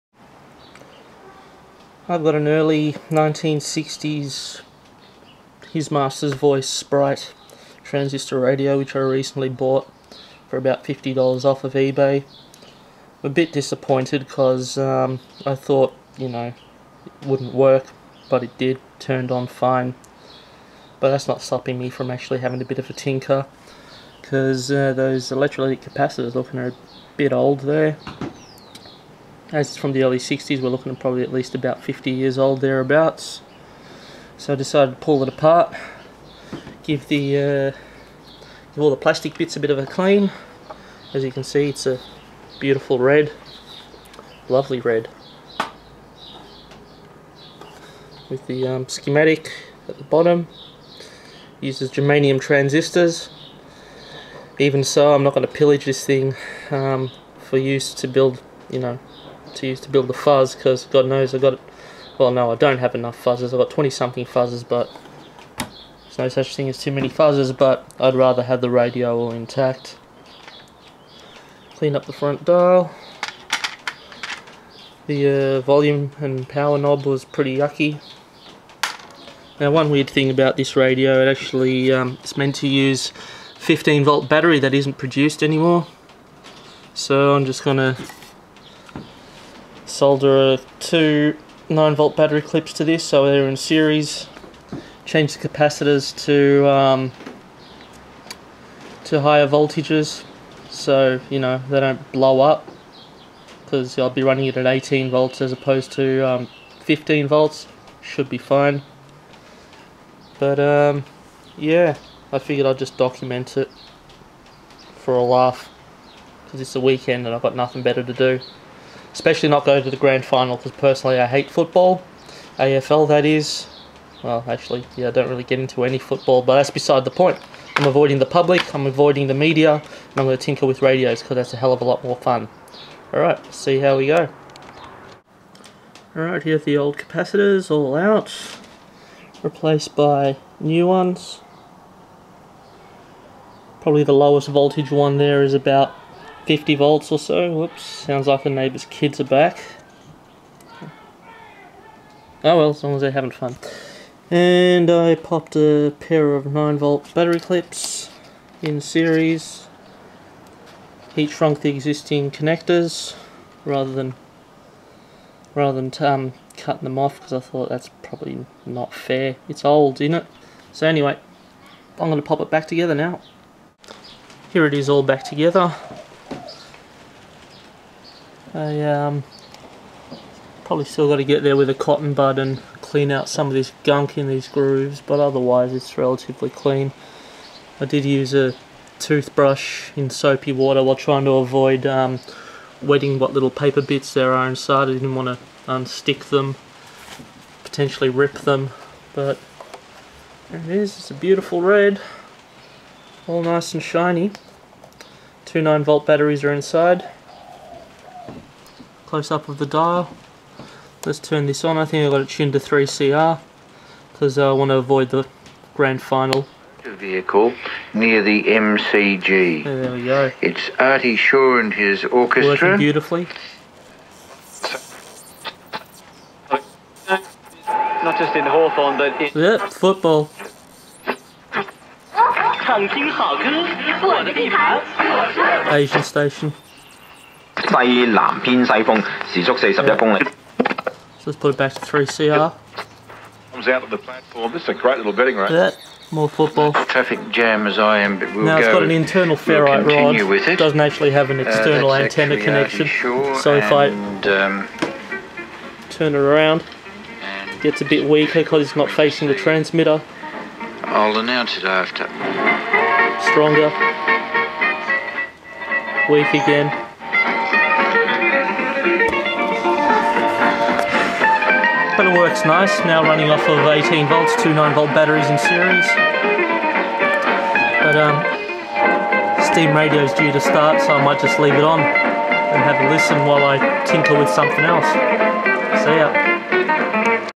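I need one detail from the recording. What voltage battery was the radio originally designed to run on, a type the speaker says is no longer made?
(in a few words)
15 volt.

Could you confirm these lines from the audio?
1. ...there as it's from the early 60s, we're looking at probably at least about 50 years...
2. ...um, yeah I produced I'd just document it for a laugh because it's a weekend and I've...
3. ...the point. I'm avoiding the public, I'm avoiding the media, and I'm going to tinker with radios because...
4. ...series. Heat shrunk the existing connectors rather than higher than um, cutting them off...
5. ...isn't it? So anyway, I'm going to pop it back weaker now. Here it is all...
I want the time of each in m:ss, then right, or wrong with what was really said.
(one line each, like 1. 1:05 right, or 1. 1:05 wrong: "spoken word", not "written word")
1. 0:27 right
2. 1:50 wrong: "figured", not "produced"
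3. 2:07 right
4. 2:38 wrong: "rather", not "higher"
5. 2:49 wrong: "together", not "weaker".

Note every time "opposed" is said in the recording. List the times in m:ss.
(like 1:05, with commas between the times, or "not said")
1:45.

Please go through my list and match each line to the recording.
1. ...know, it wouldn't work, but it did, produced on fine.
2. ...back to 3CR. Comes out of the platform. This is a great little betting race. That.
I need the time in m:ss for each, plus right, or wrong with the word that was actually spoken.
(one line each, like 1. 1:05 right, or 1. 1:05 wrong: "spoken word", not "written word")
1. 0:16 wrong: "turned", not "produced"
2. 4:01 right.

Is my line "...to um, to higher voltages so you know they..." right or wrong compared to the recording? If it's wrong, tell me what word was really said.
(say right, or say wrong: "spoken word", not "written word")
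right.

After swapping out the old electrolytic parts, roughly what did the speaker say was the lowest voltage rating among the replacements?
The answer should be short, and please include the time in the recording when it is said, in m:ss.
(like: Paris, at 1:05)
50 volts, at 2:26.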